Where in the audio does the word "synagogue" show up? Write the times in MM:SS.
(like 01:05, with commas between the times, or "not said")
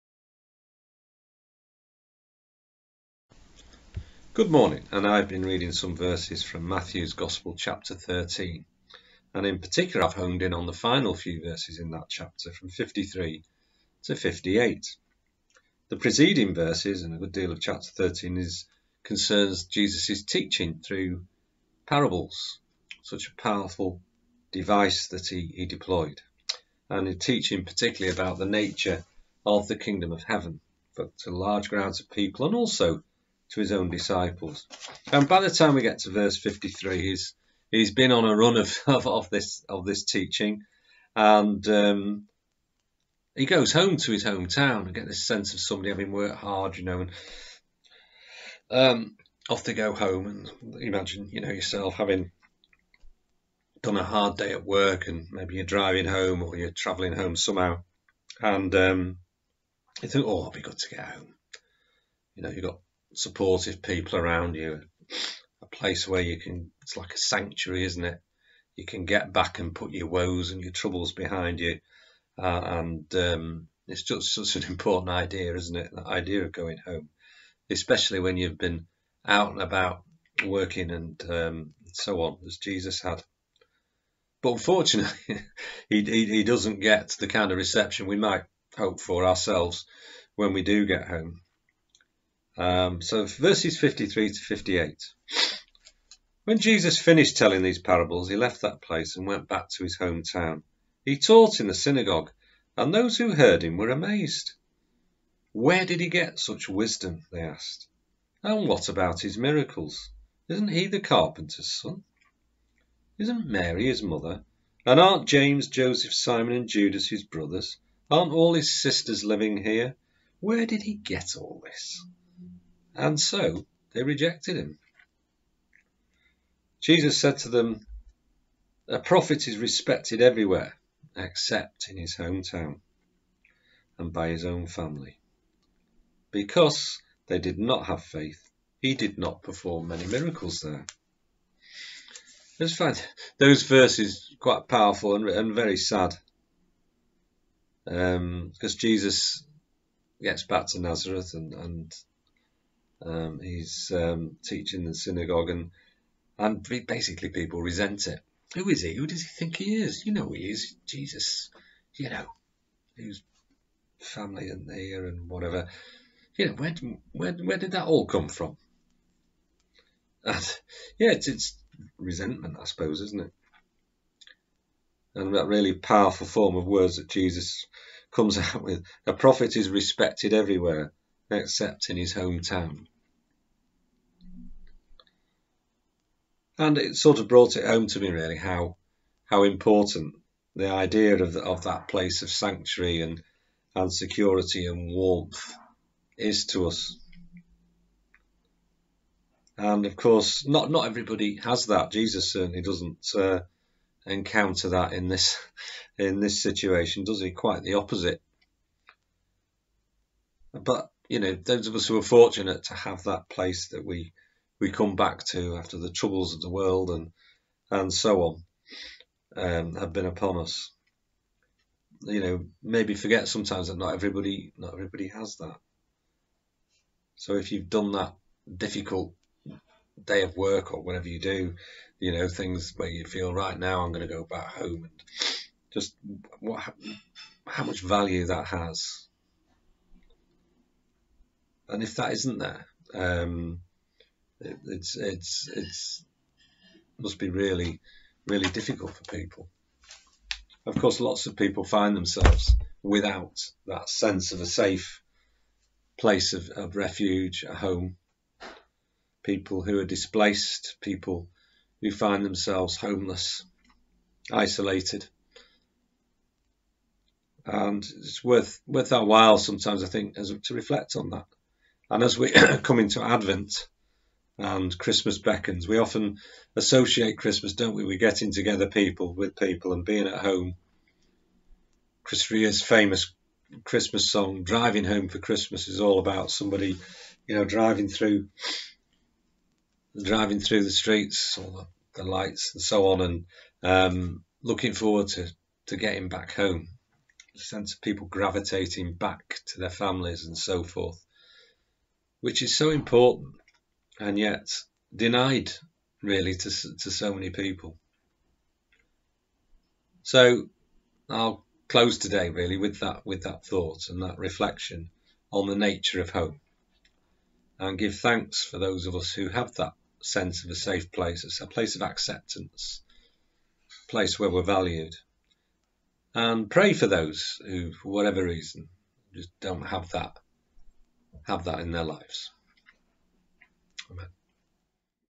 01:41, 02:34.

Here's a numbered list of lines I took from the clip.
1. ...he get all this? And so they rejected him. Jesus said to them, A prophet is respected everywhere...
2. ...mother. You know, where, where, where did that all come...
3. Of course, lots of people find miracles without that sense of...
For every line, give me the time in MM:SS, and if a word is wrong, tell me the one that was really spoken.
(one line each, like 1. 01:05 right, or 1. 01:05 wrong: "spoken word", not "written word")
1. 02:00 right
2. 02:45 wrong: "whatever", not "mother"
3. 04:10 wrong: "themselves", not "miracles".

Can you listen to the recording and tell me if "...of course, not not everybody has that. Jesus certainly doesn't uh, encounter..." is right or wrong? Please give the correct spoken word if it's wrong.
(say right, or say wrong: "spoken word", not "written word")
right.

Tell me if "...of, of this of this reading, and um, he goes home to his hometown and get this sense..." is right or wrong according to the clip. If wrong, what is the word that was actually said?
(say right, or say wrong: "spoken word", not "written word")
wrong: "teaching", not "reading".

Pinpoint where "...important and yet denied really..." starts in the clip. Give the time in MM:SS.
05:02.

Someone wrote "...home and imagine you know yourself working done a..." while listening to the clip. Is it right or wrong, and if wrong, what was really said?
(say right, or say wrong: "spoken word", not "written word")
wrong: "having", not "working".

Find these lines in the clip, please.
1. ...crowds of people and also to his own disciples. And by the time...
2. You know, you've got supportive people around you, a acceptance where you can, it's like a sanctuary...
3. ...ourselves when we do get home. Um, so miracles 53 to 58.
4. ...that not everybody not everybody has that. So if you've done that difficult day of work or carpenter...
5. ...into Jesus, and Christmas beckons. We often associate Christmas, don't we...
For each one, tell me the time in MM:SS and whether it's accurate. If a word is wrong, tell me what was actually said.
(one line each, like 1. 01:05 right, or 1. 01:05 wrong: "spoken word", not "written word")
1. 00:31 right
2. 01:02 wrong: "place", not "acceptance"
3. 01:29 wrong: "verses", not "miracles"
4. 03:43 wrong: "whatever", not "carpenter"
5. 04:32 wrong: "Advent", not "Jesus".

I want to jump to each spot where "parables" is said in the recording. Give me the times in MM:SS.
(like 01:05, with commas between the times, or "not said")
00:21, 01:37.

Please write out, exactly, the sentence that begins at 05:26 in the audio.
And pray for those who, for whatever reason, just don't have that have that in their lives.